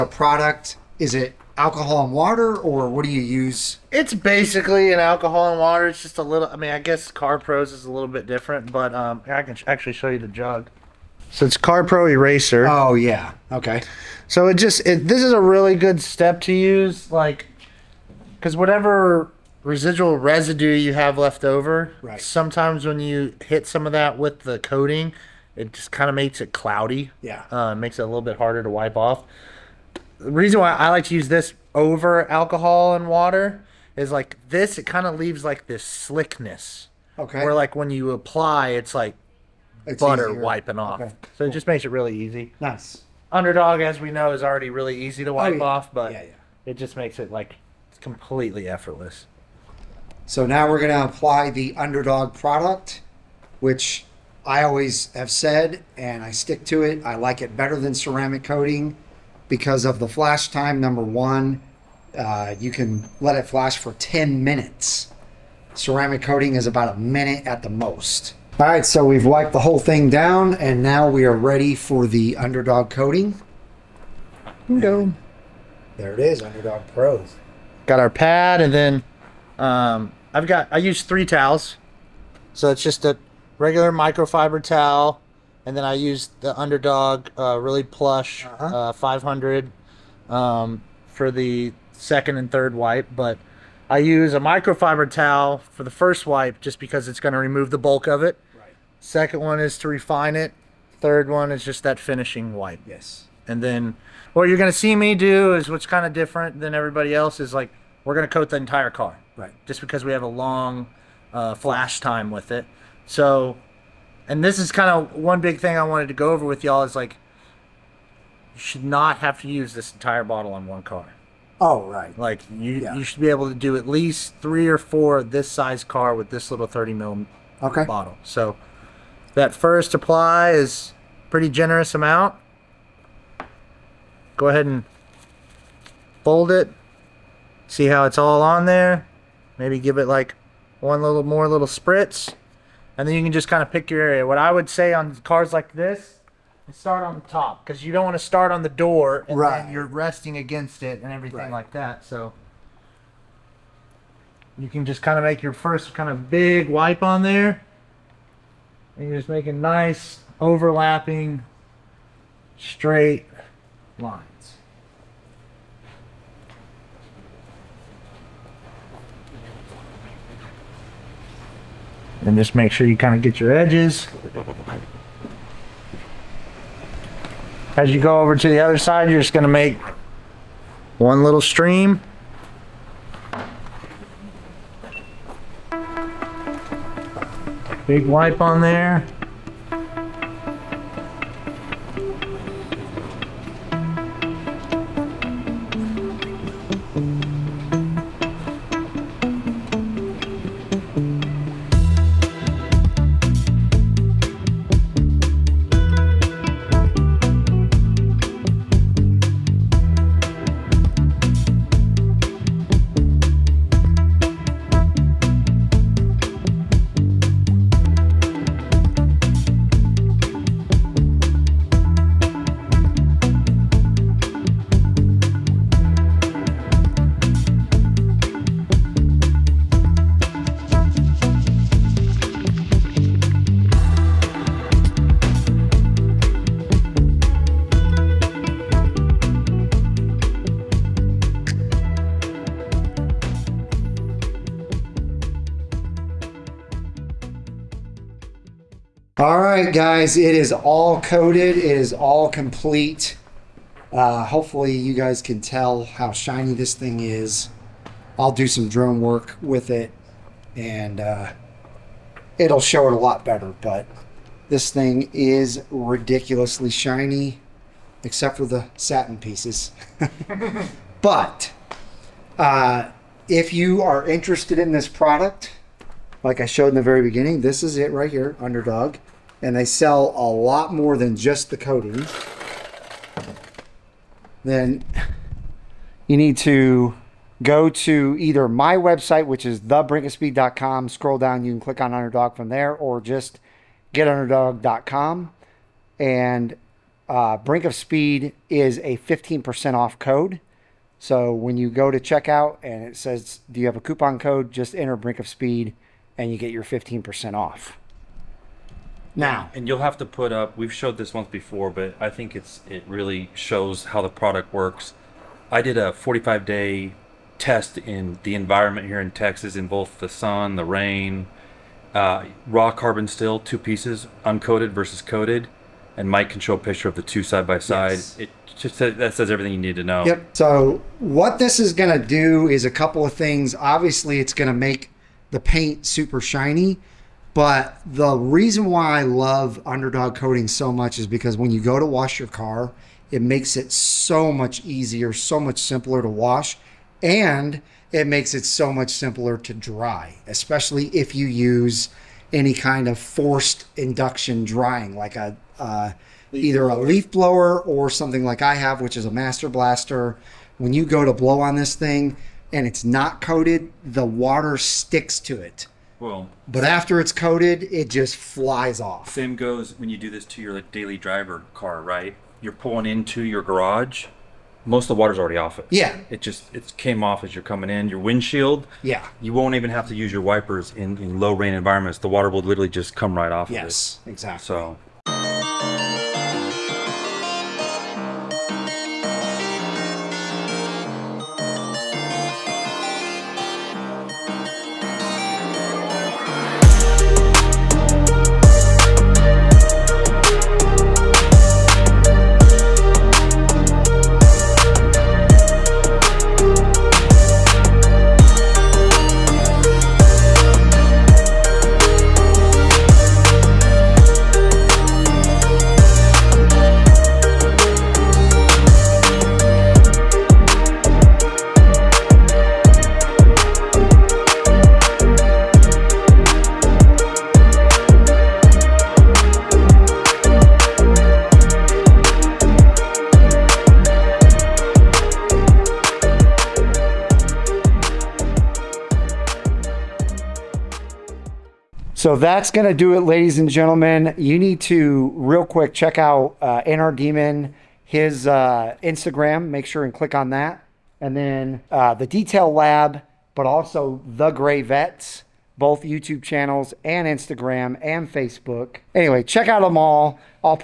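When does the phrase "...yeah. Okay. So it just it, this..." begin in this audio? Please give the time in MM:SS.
00:12.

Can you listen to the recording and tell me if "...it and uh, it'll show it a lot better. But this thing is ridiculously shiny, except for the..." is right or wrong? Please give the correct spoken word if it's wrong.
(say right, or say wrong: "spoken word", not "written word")
right.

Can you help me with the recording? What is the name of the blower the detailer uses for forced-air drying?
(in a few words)
Master Blaster.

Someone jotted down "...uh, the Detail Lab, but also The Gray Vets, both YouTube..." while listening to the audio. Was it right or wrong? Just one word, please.
right.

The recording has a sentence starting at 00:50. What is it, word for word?
So now we're going to apply the UndrDog product, which I always have said, and I stick to it.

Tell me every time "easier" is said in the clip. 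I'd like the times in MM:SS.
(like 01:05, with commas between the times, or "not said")
00:40, 05:44.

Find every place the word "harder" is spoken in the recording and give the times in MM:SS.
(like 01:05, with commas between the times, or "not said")
00:28.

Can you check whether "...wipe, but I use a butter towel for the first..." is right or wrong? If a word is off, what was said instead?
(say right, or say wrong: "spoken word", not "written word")
wrong: "microfiber", not "butter".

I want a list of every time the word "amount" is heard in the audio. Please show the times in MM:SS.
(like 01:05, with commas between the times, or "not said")
02:11.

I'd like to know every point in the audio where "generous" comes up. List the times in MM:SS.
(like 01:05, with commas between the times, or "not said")
02:11.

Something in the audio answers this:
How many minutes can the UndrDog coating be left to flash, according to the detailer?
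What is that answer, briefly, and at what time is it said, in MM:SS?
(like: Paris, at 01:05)
10, at 01:03.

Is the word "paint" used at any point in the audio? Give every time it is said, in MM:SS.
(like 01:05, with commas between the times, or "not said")
05:35.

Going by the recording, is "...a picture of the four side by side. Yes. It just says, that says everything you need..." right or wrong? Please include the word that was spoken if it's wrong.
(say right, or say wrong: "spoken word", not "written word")
wrong: "two", not "four".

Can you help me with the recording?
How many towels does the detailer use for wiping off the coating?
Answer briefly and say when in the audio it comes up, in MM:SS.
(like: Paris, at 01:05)
3, at 01:21.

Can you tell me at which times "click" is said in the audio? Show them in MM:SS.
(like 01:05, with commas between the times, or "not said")
04:51, 07:29.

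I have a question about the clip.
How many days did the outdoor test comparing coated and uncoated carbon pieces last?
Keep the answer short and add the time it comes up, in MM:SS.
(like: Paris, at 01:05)
45, at 05:15.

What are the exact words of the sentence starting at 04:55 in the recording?
And uh, Brink of Speed is a 15% off code.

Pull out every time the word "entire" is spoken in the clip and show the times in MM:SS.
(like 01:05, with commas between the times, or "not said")
01:48, 01:59.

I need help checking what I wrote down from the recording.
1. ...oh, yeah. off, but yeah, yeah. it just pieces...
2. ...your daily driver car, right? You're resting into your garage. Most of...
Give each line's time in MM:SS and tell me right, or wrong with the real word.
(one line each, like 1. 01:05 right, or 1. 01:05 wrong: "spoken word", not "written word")
1. 00:45 wrong: "makes", not "pieces"
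2. 06:10 wrong: "pulling", not "resting".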